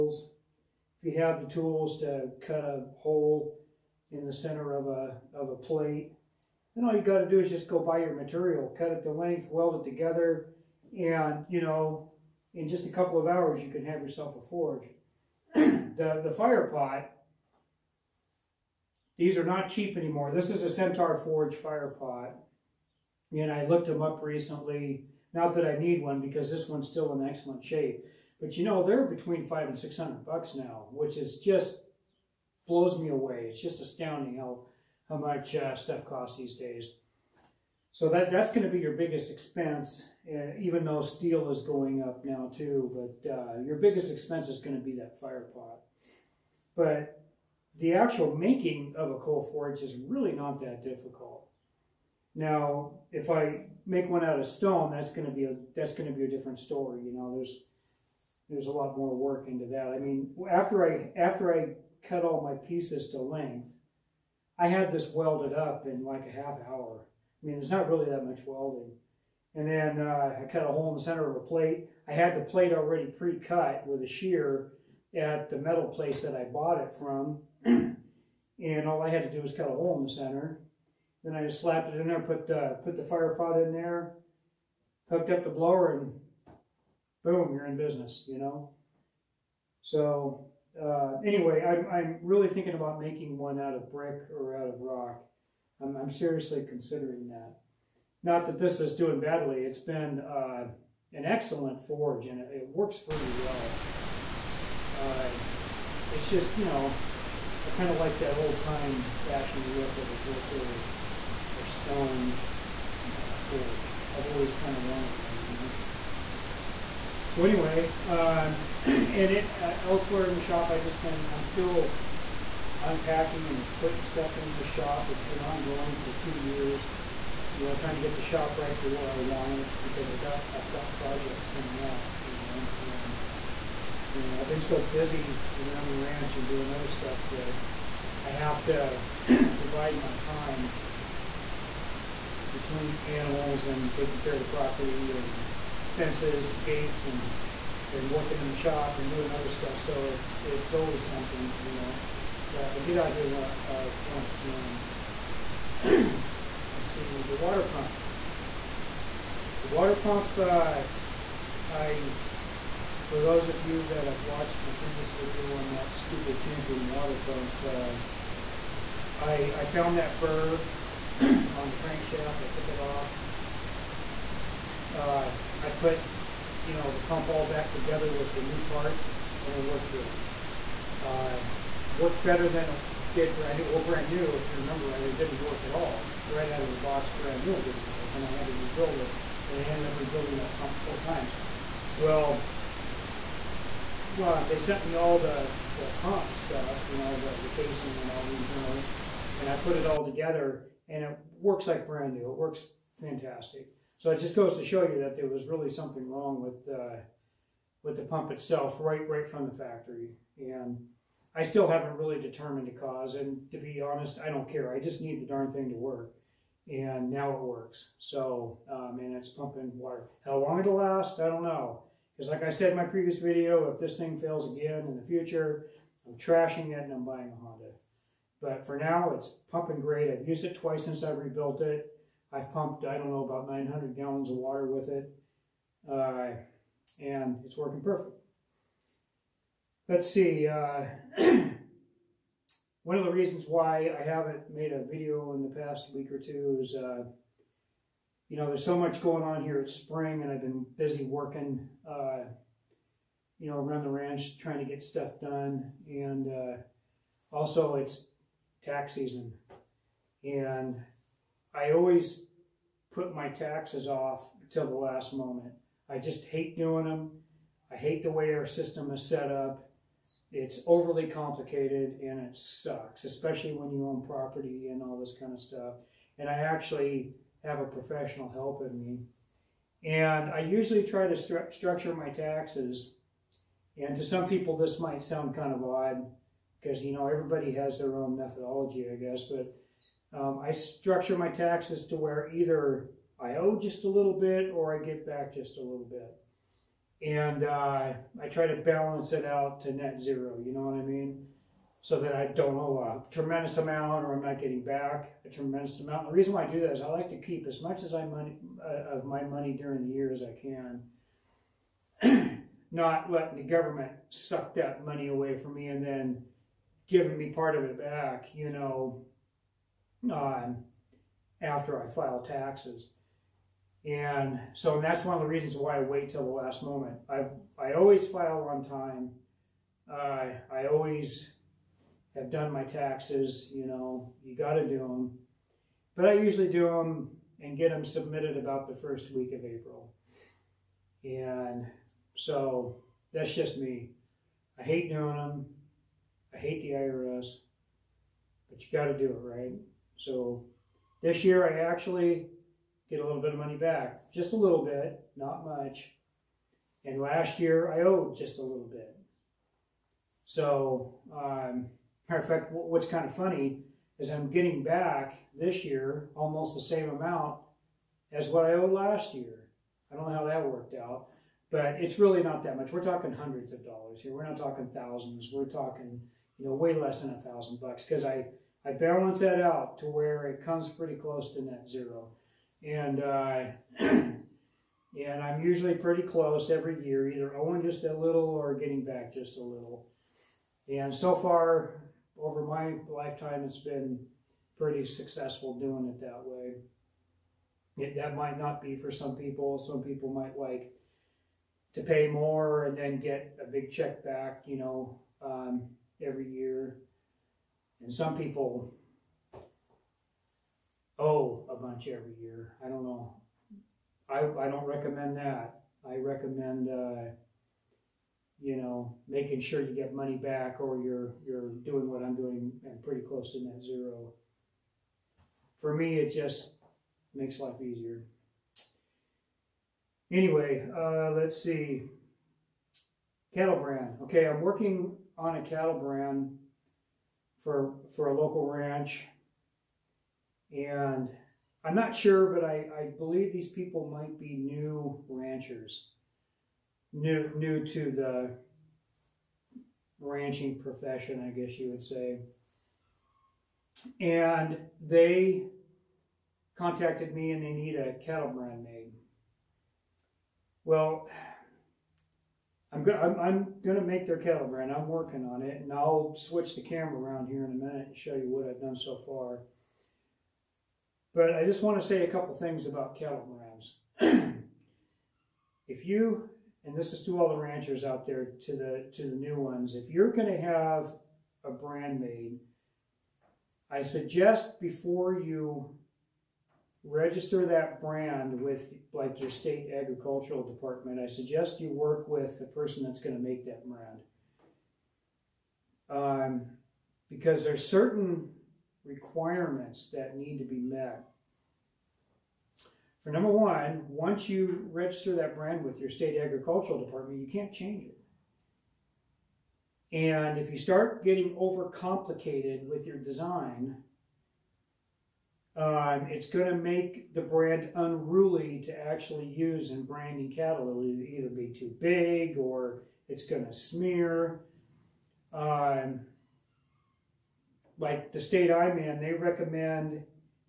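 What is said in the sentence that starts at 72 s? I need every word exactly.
I had the plate already pre-cut with a shear at the metal place that I bought it from.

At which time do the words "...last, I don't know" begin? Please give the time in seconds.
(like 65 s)
220 s.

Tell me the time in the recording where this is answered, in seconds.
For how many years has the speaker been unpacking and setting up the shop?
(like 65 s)
126 s.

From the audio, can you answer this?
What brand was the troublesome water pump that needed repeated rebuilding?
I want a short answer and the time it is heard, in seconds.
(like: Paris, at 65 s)
Champion, at 166 s.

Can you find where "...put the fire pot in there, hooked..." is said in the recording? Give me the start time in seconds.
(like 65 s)
82 s.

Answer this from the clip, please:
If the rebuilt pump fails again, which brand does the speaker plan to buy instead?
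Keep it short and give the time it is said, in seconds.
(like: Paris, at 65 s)
Honda, at 227 s.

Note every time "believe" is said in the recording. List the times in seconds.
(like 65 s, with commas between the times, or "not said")
442 s.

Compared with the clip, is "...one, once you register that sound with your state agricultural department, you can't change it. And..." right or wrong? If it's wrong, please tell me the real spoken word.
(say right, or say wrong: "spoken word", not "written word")
wrong: "brand", not "sound".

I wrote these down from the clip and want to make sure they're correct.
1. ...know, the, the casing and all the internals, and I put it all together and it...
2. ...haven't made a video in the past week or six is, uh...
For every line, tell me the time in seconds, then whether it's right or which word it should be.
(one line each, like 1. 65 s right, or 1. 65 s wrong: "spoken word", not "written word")
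1. 196 s right
2. 244 s wrong: "two", not "six".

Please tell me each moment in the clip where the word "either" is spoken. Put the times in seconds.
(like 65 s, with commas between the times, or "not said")
292 s, 387 s, 521 s.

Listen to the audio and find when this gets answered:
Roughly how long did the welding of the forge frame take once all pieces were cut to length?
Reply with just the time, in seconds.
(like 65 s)
66 s.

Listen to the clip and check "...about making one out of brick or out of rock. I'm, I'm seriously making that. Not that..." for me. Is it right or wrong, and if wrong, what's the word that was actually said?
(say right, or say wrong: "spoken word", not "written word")
wrong: "considering", not "making".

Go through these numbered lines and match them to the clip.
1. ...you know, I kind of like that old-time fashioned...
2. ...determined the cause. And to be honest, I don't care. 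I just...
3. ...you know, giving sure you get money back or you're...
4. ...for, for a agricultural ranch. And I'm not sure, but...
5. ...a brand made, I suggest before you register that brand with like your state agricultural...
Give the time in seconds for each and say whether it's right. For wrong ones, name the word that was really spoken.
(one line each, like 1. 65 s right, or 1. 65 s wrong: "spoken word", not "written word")
1. 106 s right
2. 212 s right
3. 418 s wrong: "making", not "giving"
4. 437 s wrong: "local", not "agricultural"
5. 481 s right.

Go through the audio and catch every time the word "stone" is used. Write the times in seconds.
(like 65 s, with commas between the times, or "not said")
54 s, 111 s.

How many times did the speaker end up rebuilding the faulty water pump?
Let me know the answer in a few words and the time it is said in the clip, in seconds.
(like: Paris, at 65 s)
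4, at 190 s.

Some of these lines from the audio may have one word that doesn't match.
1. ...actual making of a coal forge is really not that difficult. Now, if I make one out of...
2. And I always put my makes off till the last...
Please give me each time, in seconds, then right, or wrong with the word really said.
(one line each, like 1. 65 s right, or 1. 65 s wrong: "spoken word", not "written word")
1. 47 s right
2. 260 s wrong: "taxes", not "makes".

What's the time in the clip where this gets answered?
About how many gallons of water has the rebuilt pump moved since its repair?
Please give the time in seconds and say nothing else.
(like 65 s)
233 s.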